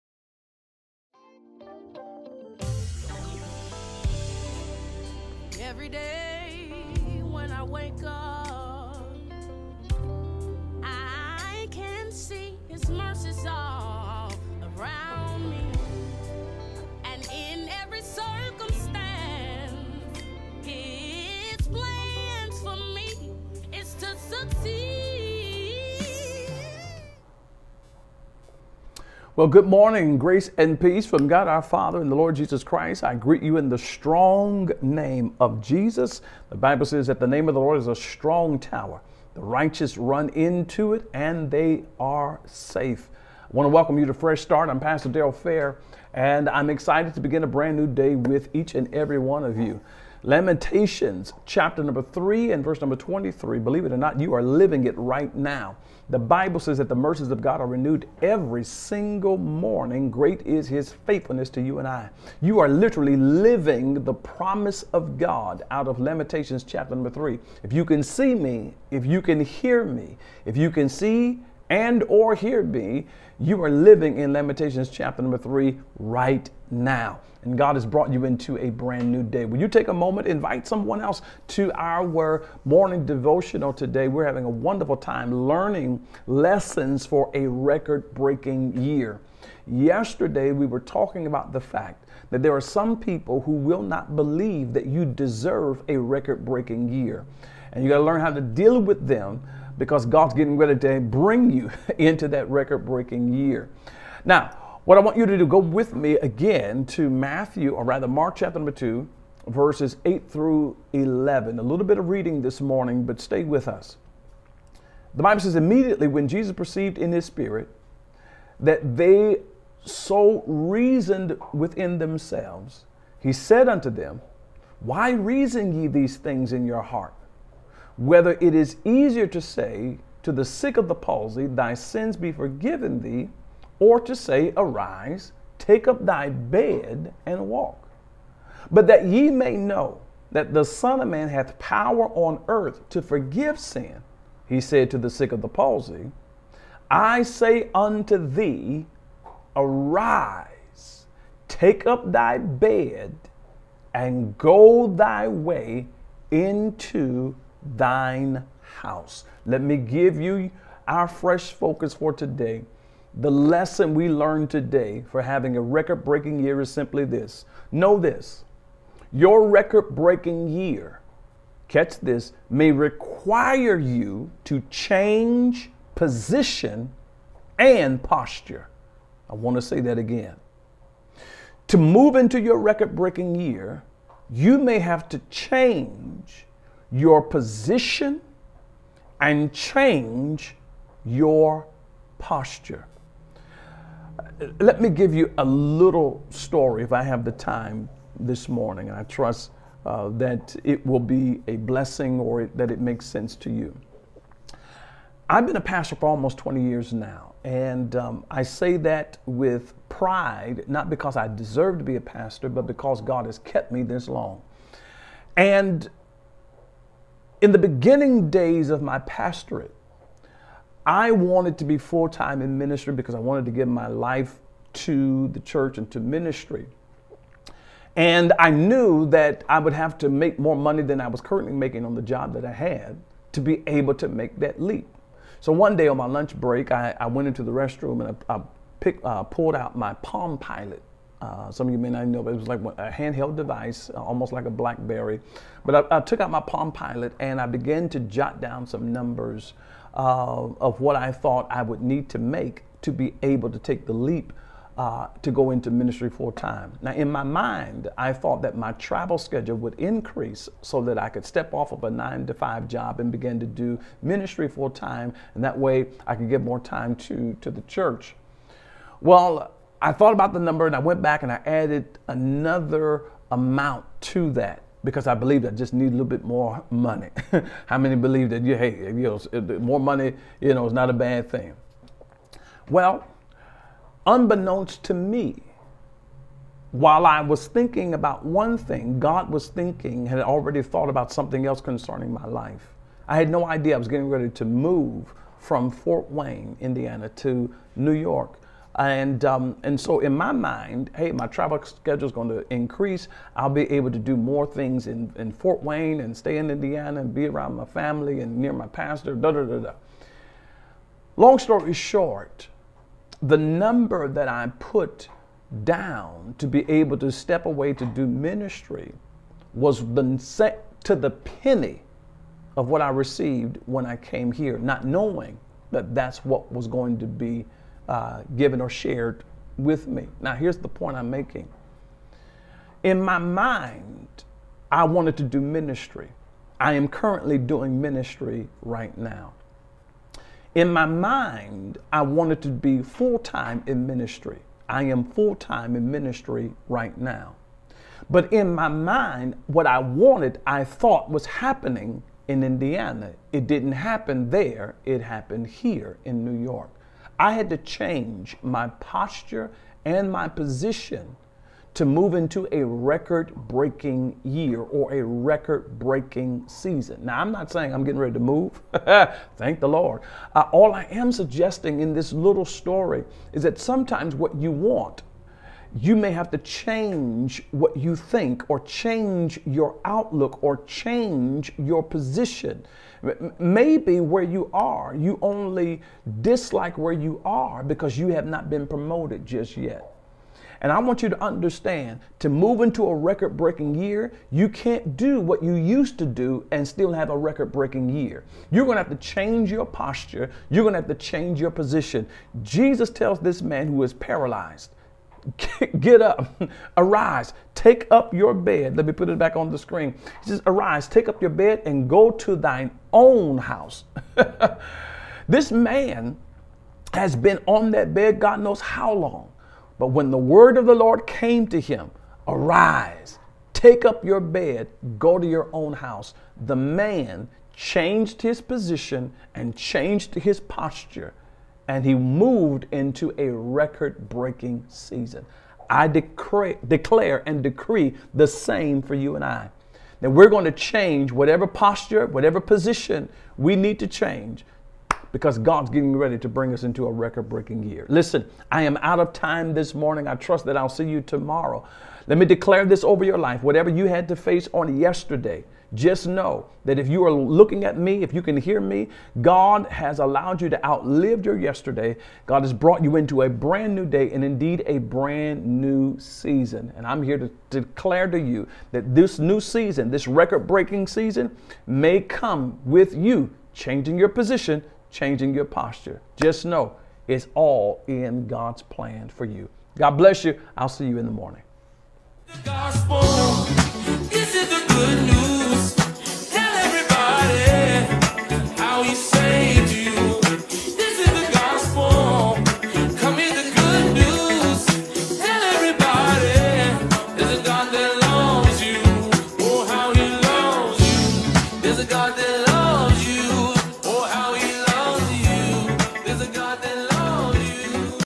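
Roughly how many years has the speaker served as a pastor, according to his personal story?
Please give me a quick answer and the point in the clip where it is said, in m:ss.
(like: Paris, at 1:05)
almost 20 years, at 3:26.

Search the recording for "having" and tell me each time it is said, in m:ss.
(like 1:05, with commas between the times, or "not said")
1:24, 2:45.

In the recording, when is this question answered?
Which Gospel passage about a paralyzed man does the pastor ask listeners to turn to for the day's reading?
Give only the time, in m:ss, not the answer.
1:48.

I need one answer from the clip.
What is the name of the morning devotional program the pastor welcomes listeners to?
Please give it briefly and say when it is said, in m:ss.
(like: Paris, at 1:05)
Fresh Start, at 0:44.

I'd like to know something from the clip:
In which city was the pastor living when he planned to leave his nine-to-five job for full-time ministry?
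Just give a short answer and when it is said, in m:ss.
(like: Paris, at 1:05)
Fort Wayne, Indiana, at 4:55.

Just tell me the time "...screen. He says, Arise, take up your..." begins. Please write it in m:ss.
6:49.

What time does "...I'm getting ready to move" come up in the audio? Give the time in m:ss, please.
6:07.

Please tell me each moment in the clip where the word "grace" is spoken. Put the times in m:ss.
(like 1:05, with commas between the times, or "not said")
0:30.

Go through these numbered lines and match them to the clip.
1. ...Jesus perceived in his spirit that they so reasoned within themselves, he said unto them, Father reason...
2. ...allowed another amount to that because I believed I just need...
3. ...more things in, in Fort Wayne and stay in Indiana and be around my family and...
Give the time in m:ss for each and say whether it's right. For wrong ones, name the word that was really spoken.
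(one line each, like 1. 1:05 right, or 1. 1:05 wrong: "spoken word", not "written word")
1. 1:56 wrong: "Why", not "Father"
2. 4:31 wrong: "added", not "allowed"
3. 5:04 right.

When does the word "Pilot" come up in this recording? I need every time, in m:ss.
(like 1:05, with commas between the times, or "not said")
4:00, 4:06.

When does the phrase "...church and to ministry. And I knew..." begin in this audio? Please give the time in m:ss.
3:45.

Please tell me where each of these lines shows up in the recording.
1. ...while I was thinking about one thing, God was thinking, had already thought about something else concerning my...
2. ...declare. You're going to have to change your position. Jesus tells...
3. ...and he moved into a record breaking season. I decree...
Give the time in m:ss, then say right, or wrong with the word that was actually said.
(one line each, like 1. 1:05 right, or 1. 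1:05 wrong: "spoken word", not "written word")
1. 4:46 right
2. 6:39 wrong: "posture", not "declare"
3. 7:11 right.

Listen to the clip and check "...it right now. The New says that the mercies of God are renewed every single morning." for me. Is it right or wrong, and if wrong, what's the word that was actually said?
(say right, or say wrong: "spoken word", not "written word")
wrong: "Bible", not "New".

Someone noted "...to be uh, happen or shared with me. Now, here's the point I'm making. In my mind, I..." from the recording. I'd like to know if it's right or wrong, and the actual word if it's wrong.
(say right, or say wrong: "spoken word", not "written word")
wrong: "given", not "happen".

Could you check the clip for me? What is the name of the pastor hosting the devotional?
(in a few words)
Darrell Fair.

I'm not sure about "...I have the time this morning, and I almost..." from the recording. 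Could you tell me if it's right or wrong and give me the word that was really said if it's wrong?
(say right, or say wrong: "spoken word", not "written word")
wrong: "trust", not "almost".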